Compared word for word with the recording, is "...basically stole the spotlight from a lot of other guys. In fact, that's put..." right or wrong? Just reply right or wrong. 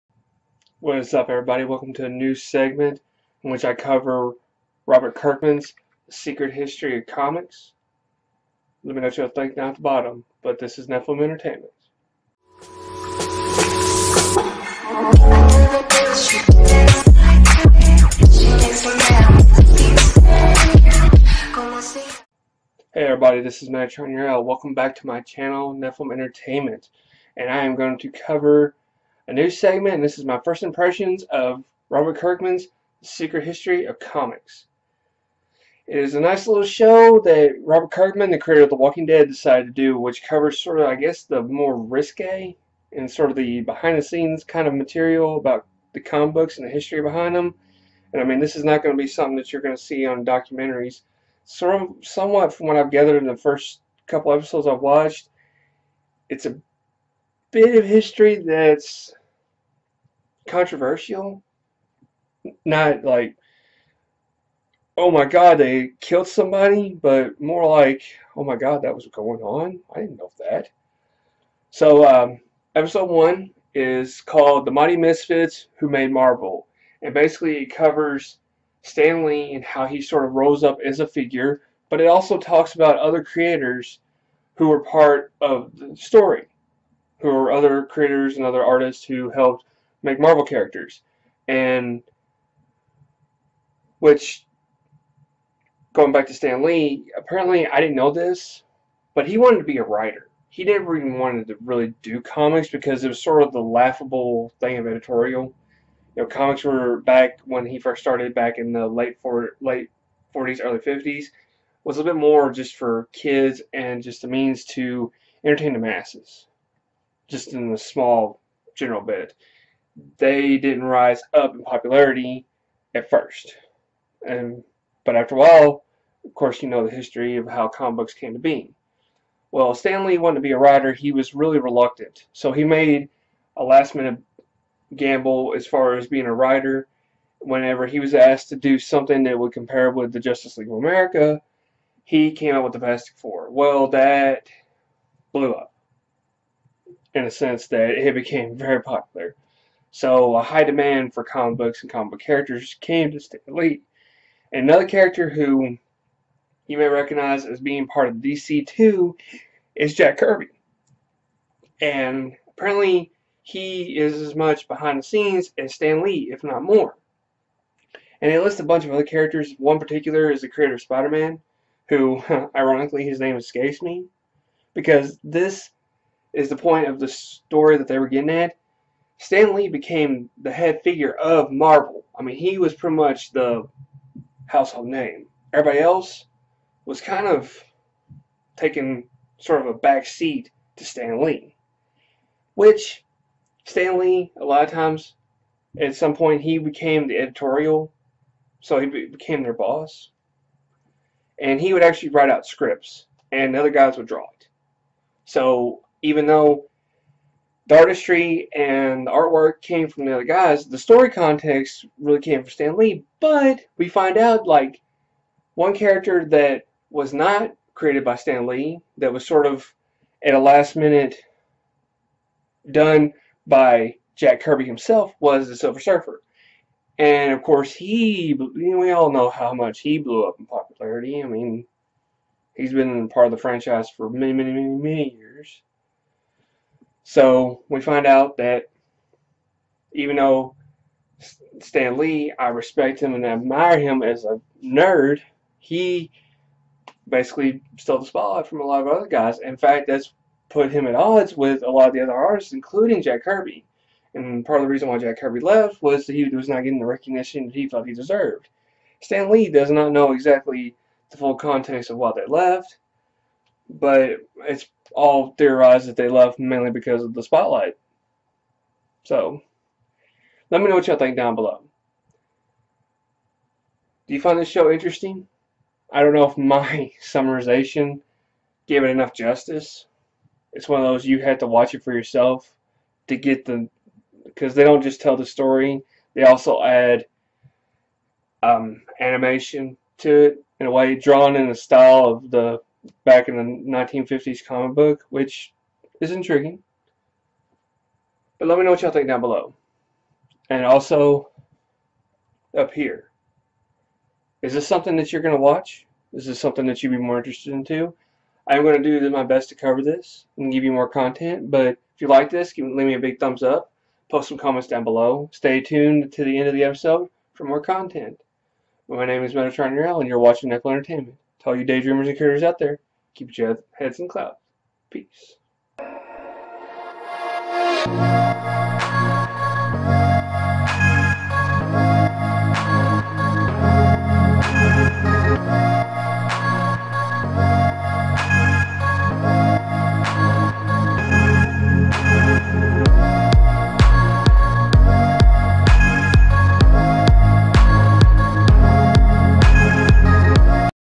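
right.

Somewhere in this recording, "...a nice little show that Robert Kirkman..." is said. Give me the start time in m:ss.
0:36.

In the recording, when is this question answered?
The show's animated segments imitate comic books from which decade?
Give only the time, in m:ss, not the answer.
4:53.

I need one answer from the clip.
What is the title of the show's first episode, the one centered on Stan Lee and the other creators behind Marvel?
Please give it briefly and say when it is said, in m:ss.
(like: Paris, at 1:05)
The Mighty Misfits Who Made Marvel, at 1:14.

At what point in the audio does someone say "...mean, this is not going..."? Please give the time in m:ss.
0:48.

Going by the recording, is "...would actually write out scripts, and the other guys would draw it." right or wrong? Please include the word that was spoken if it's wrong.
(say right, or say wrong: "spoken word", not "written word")
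right.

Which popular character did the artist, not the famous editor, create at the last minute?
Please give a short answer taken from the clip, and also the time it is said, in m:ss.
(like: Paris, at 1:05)
Silver Surfer, at 3:45.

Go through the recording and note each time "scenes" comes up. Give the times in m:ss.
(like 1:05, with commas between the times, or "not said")
0:44, 2:45.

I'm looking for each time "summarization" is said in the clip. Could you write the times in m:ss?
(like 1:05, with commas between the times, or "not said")
4:37.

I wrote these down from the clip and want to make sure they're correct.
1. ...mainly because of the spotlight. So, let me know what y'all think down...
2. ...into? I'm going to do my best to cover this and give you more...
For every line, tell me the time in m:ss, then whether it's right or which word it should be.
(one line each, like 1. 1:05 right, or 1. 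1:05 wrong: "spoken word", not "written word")
1. 4:26 right
2. 5:07 right.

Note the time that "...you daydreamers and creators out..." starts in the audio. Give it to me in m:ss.
5:21.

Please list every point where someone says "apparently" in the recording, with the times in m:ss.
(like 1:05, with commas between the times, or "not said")
1:37, 2:42.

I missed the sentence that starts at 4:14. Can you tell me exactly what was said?
And part of the reason why Jack Kirby left was that he was not getting the recognition that he felt he deserved.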